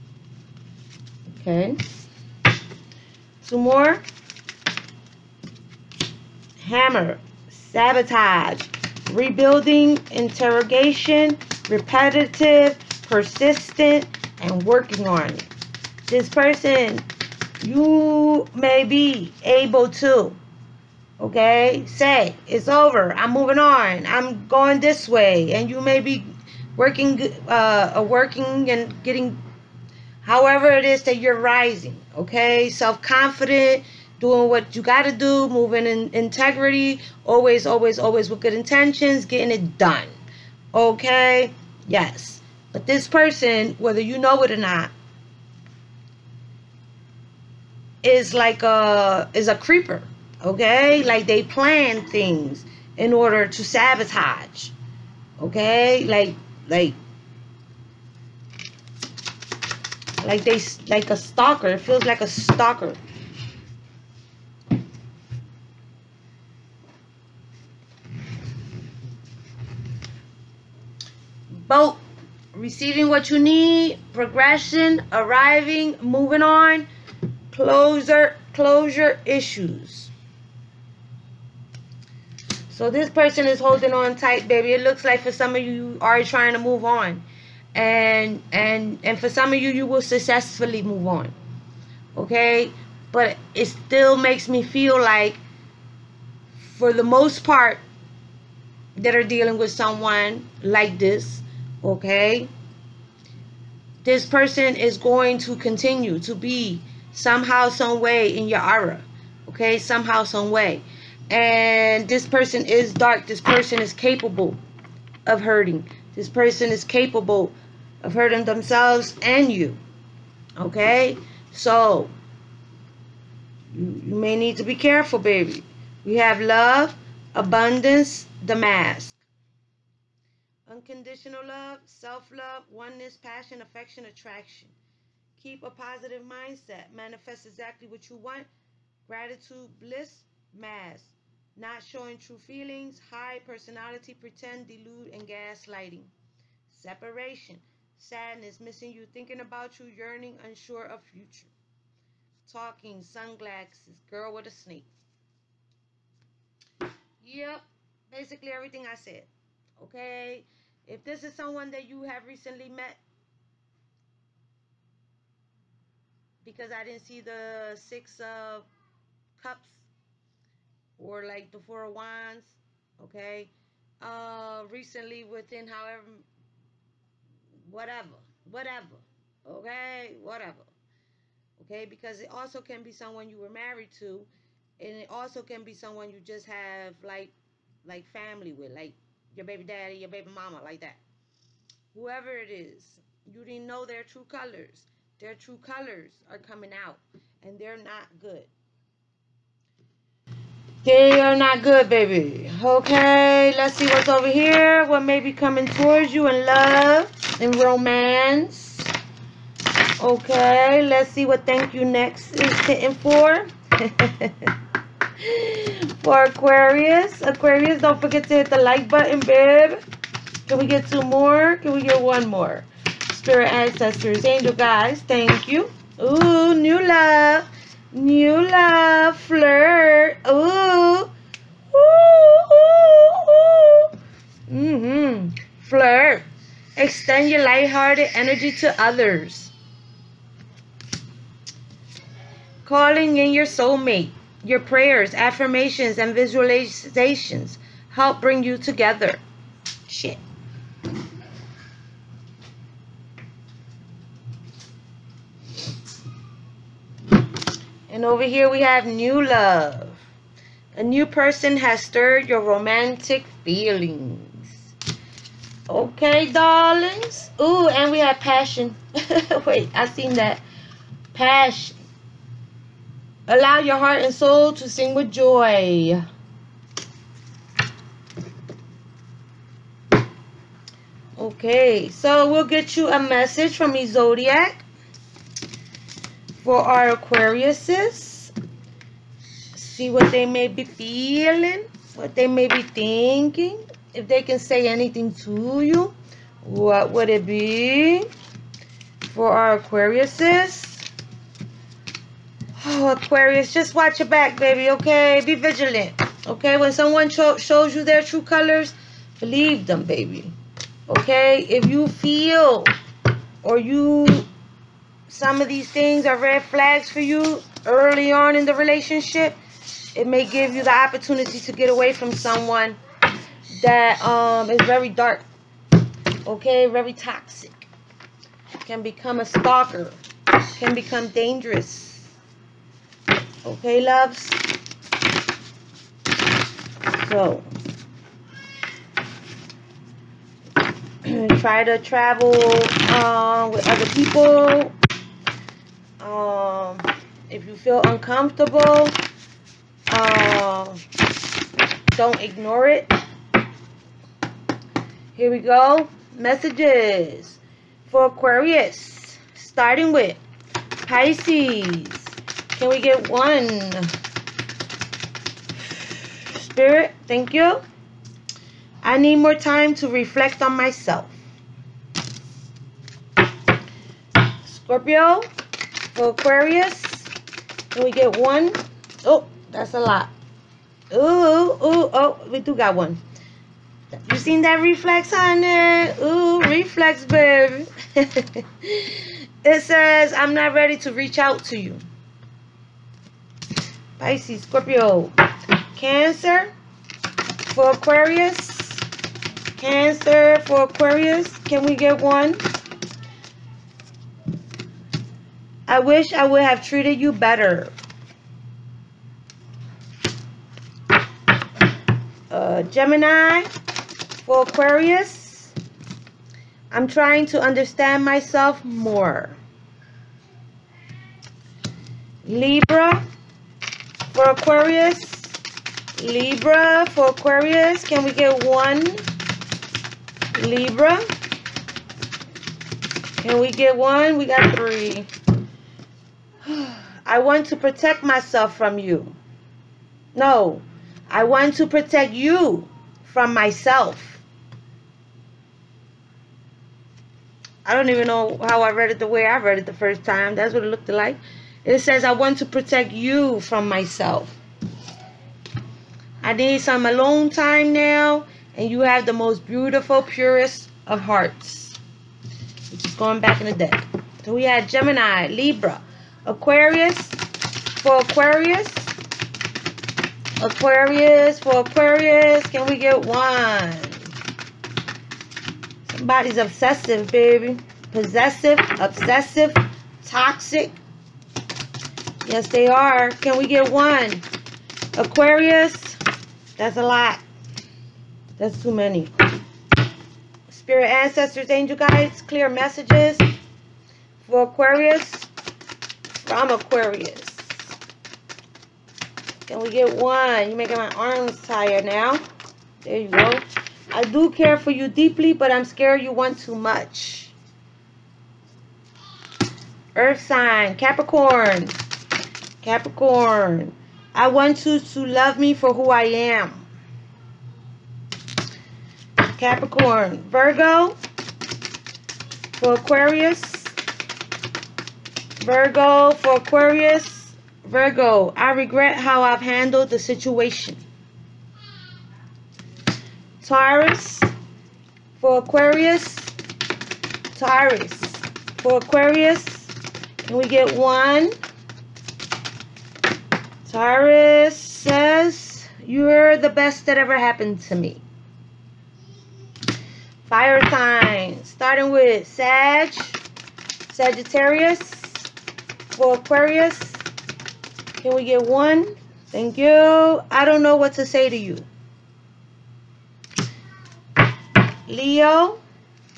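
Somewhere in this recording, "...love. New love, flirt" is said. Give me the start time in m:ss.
3:46.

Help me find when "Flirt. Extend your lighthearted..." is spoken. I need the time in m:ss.
3:55.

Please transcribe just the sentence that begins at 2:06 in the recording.
We have love, abundance, the mask.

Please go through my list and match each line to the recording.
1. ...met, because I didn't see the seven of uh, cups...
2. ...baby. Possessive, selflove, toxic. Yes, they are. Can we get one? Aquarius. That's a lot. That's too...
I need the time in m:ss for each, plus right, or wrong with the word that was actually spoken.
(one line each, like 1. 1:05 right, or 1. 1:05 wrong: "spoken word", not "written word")
1. 2:42 wrong: "six", not "seven"
2. 7:57 wrong: "obsessive", not "selflove".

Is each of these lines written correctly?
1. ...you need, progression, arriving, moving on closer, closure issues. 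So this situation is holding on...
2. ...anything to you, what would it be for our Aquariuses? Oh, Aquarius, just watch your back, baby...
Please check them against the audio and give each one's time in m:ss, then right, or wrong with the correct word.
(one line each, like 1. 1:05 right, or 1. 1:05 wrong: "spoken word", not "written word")
1. 1:13 wrong: "person", not "situation"
2. 4:54 right.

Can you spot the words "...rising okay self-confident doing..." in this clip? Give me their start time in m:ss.
0:31.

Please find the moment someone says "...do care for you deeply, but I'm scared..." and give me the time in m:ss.
8:24.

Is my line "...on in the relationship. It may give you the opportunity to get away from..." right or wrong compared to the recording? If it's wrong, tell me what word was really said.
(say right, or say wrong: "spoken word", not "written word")
right.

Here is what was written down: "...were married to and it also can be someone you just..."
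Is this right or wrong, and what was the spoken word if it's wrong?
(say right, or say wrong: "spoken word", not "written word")
right.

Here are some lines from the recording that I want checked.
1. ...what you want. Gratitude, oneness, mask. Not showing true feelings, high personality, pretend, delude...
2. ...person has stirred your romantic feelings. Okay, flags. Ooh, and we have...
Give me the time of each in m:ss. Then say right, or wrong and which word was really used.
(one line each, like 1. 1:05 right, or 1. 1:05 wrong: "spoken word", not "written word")
1. 2:17 wrong: "bliss", not "oneness"
2. 4:21 wrong: "darlings", not "flags".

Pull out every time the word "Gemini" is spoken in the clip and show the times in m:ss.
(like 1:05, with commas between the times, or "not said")
6:52, 7:44.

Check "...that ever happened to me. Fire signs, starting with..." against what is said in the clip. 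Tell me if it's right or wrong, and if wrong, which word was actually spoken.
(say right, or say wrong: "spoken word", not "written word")
right.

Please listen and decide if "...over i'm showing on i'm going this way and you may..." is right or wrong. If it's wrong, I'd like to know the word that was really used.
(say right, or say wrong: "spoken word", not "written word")
wrong: "moving", not "showing".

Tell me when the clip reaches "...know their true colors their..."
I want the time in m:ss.
3:13.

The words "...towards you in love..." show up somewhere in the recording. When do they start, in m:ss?
3:25.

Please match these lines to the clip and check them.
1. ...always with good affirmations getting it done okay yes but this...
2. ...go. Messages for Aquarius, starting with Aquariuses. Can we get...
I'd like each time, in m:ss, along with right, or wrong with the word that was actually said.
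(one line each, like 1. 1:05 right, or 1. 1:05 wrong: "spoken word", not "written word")
1. 0:37 wrong: "intentions", not "affirmations"
2. 5:55 wrong: "Pisces", not "Aquariuses".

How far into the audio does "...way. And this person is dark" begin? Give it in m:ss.
1:50.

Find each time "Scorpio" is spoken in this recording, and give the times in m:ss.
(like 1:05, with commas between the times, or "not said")
6:14, 6:34.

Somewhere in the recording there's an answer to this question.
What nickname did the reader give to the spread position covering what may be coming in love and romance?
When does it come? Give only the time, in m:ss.
3:31.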